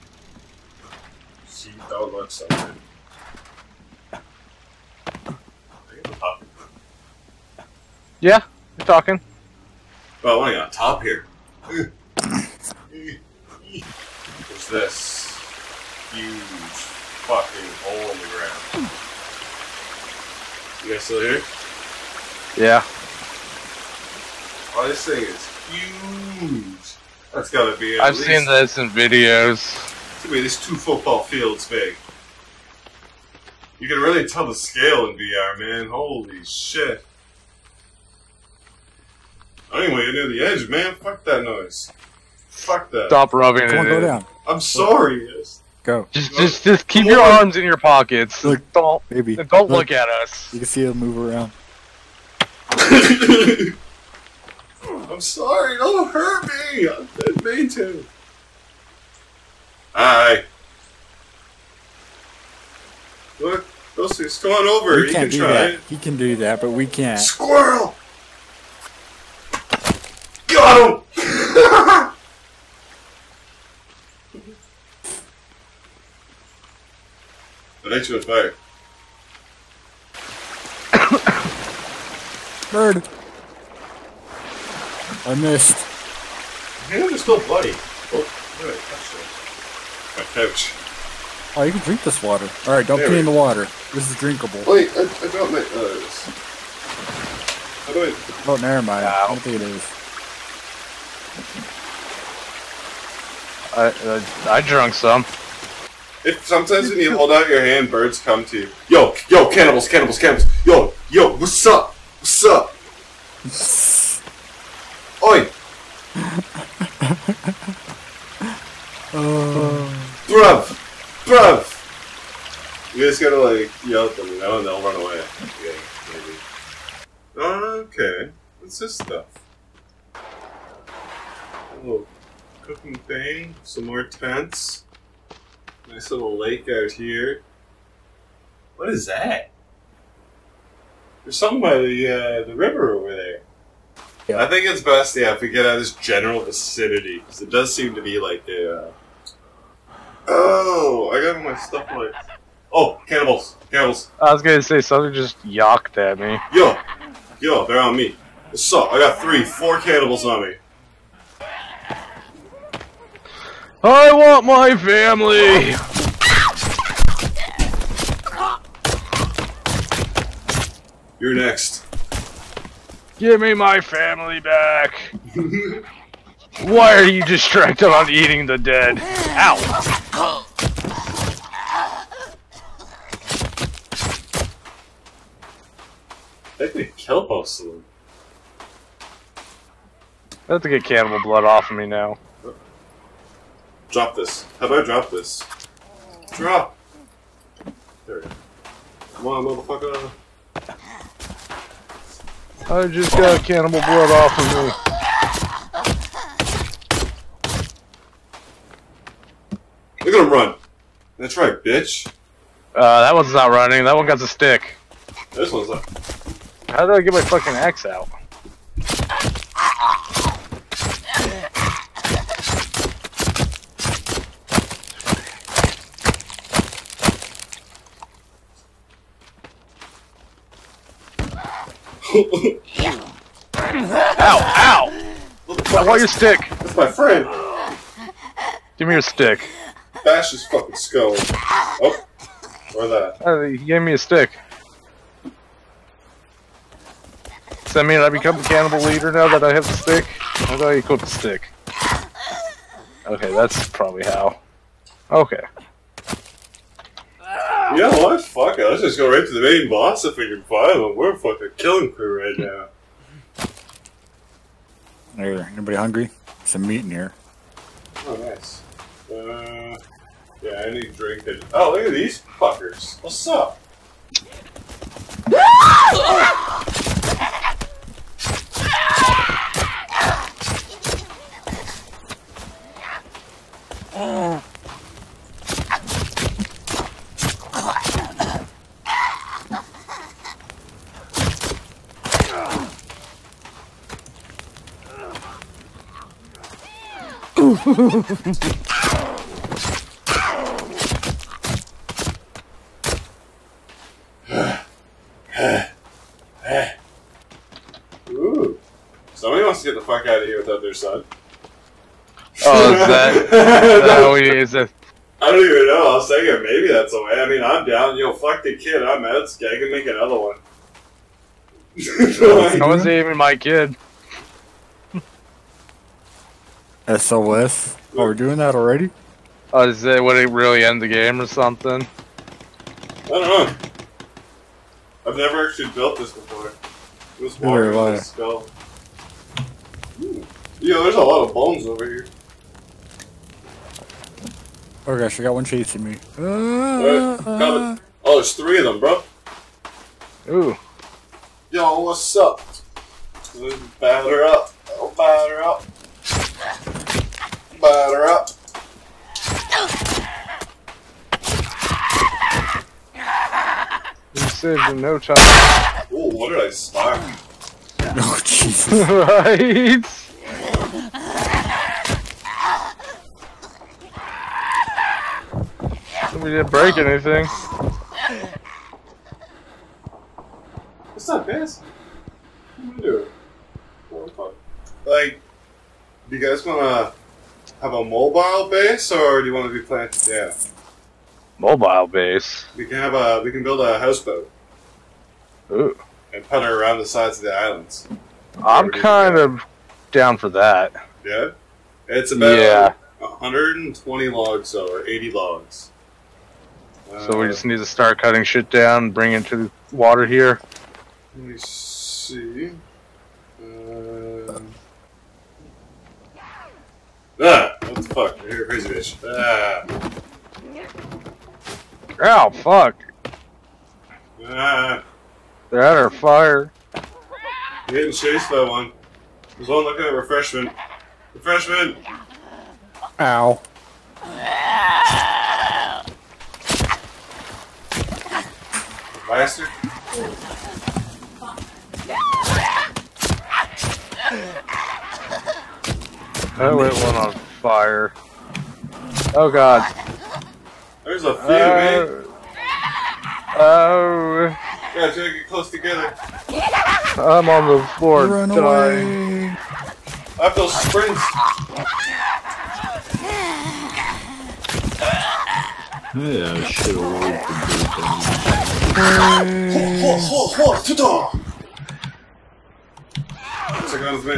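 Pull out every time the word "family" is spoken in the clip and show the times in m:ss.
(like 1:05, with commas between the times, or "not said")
2:44, 2:53.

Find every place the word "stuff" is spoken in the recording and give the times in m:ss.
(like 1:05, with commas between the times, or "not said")
2:08, 2:31.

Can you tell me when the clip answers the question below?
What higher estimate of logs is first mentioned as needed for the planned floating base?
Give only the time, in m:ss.
6:42.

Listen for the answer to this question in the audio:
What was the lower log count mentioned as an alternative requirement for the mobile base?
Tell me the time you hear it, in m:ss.
6:44.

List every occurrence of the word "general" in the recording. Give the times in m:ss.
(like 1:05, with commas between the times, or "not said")
2:25.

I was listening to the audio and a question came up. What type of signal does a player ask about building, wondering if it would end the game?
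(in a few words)
SOS.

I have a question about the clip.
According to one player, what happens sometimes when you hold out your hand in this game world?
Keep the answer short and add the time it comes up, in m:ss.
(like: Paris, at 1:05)
Birds come to you, at 1:47.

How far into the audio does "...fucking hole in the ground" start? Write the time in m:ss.
0:17.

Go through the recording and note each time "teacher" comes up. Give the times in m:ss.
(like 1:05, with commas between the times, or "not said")
not said.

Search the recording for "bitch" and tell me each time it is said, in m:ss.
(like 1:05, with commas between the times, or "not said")
3:31, 6:58.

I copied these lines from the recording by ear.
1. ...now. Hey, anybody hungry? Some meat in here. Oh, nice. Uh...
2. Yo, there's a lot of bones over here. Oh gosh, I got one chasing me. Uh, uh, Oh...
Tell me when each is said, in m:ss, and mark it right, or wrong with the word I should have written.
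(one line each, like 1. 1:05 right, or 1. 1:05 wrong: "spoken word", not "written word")
1. 4:22 right
2. 5:40 right.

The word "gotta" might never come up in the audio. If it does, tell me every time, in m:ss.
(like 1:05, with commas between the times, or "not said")
0:27, 2:03, 7:34.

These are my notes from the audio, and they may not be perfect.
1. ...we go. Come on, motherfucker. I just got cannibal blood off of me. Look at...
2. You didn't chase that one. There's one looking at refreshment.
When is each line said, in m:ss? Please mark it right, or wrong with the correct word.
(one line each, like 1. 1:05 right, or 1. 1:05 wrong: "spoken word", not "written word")
1. 3:18 right
2. 7:07 right.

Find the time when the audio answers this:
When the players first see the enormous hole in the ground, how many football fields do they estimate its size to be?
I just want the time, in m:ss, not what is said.
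0:30.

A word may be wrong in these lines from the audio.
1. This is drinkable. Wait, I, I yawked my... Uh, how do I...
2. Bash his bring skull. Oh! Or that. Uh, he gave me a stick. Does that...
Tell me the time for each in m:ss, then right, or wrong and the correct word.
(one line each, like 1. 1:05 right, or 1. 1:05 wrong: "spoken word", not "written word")
1. 1:33 wrong: "dropped", not "yawked"
2. 4:00 wrong: "fucking", not "bring".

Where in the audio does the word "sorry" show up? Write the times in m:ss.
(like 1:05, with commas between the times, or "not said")
0:44, 0:55.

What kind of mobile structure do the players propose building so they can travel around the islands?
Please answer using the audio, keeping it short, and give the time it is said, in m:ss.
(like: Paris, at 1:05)
A houseboat, at 6:33.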